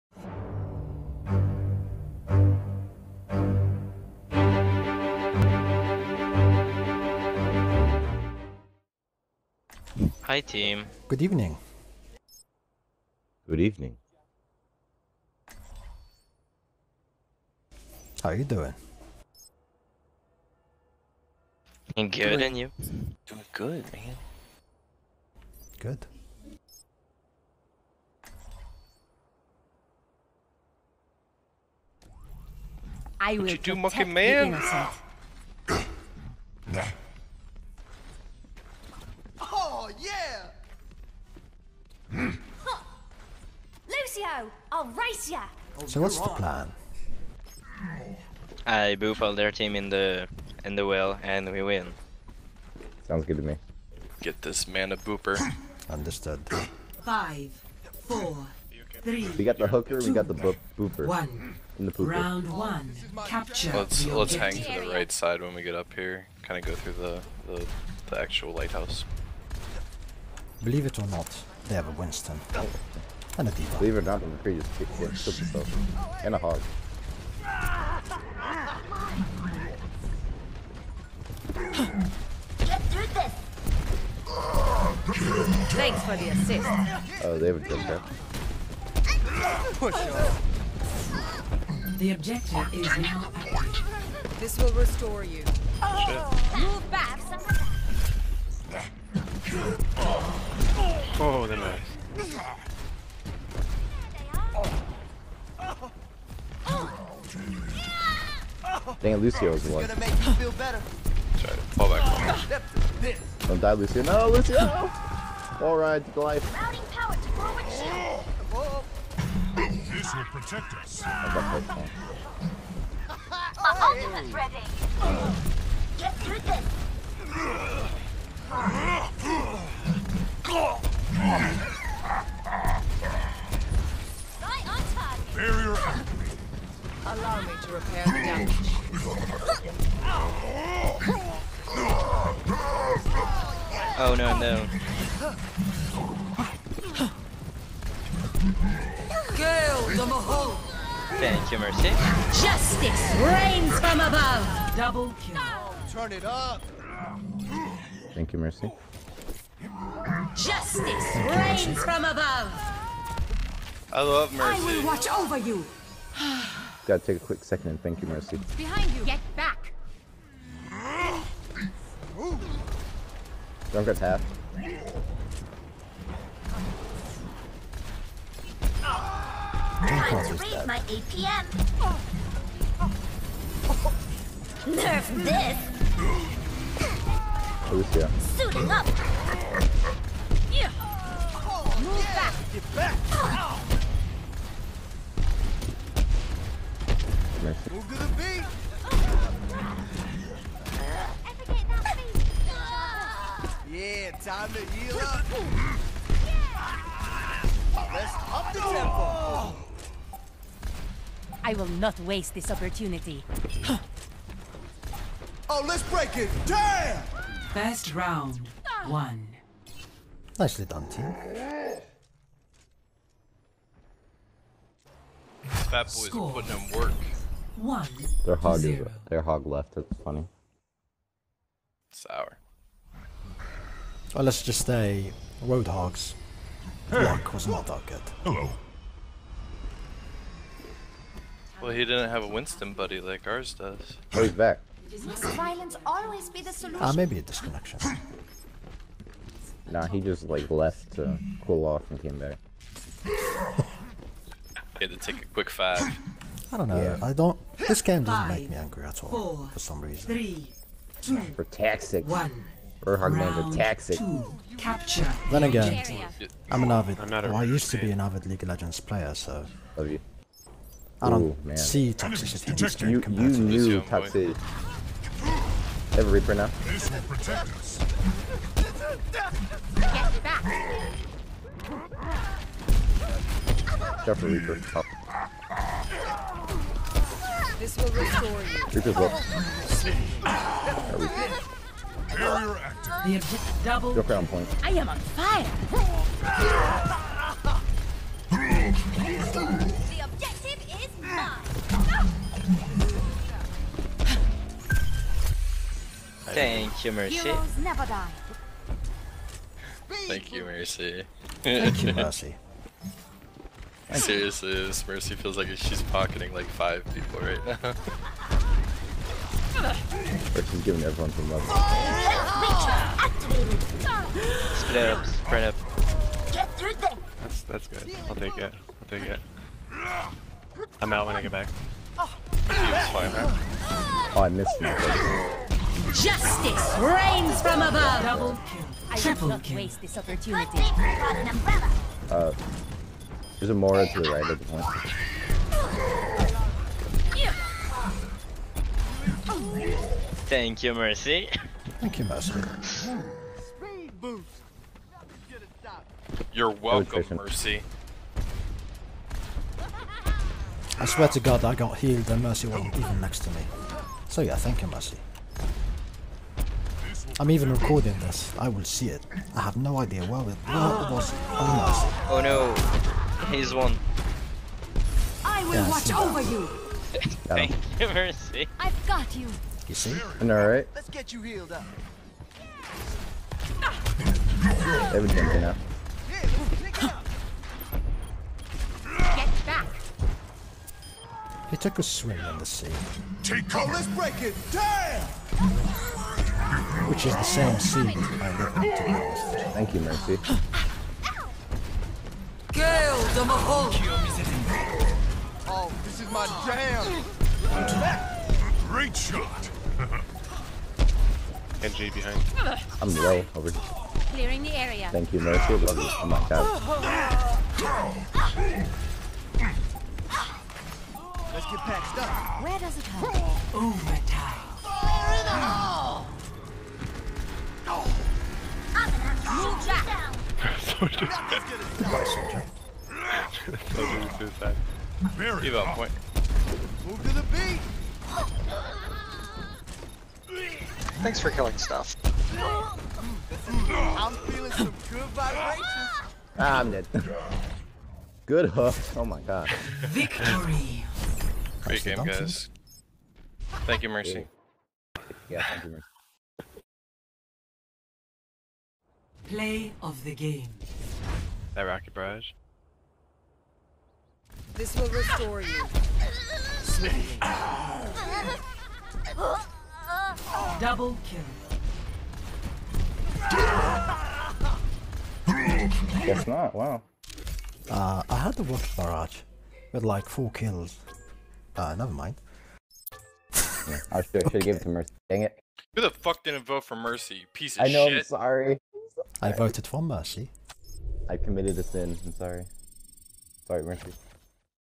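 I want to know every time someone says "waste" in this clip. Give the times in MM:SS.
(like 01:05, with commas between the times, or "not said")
03:32, 05:39.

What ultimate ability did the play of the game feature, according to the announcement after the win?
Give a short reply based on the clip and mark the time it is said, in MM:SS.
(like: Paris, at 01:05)
rocket barrage, at 07:41.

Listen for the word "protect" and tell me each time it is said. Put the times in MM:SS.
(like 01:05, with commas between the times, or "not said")
02:00, 04:37.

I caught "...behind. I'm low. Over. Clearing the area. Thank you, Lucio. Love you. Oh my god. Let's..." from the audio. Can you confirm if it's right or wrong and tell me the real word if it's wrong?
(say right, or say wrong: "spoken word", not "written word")
wrong: "Mercy", not "Lucio".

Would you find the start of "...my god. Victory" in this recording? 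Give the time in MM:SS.
07:29.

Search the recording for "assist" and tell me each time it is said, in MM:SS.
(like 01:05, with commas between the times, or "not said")
01:26.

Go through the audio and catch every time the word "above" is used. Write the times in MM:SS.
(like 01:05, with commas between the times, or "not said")
02:33, 02:42, 05:37.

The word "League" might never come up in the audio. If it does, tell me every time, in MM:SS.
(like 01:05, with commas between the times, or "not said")
04:28.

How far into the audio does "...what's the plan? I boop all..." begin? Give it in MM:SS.
00:46.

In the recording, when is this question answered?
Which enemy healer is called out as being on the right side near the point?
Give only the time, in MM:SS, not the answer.
05:43.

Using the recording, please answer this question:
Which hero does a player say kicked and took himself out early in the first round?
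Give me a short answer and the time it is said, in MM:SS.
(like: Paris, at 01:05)
McCree, at 01:14.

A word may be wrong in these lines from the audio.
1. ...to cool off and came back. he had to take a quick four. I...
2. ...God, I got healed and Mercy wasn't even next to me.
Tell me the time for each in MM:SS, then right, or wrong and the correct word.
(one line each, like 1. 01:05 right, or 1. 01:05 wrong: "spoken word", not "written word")
1. 04:10 wrong: "five", not "four"
2. 06:01 right.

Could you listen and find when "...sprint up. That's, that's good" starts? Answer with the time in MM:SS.
05:25.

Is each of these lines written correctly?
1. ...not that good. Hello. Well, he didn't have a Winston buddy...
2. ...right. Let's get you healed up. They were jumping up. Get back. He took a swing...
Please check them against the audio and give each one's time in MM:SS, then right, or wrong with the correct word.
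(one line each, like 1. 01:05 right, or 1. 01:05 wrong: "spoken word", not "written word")
1. 03:57 right
2. 06:20 right.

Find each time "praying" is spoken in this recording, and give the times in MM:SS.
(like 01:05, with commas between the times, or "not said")
not said.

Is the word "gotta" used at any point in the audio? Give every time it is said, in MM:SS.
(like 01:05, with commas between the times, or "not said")
02:46.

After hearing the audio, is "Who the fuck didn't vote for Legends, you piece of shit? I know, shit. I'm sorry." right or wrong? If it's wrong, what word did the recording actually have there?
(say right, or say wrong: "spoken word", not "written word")
wrong: "Mercy", not "Legends".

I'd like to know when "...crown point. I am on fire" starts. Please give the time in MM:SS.
04:54.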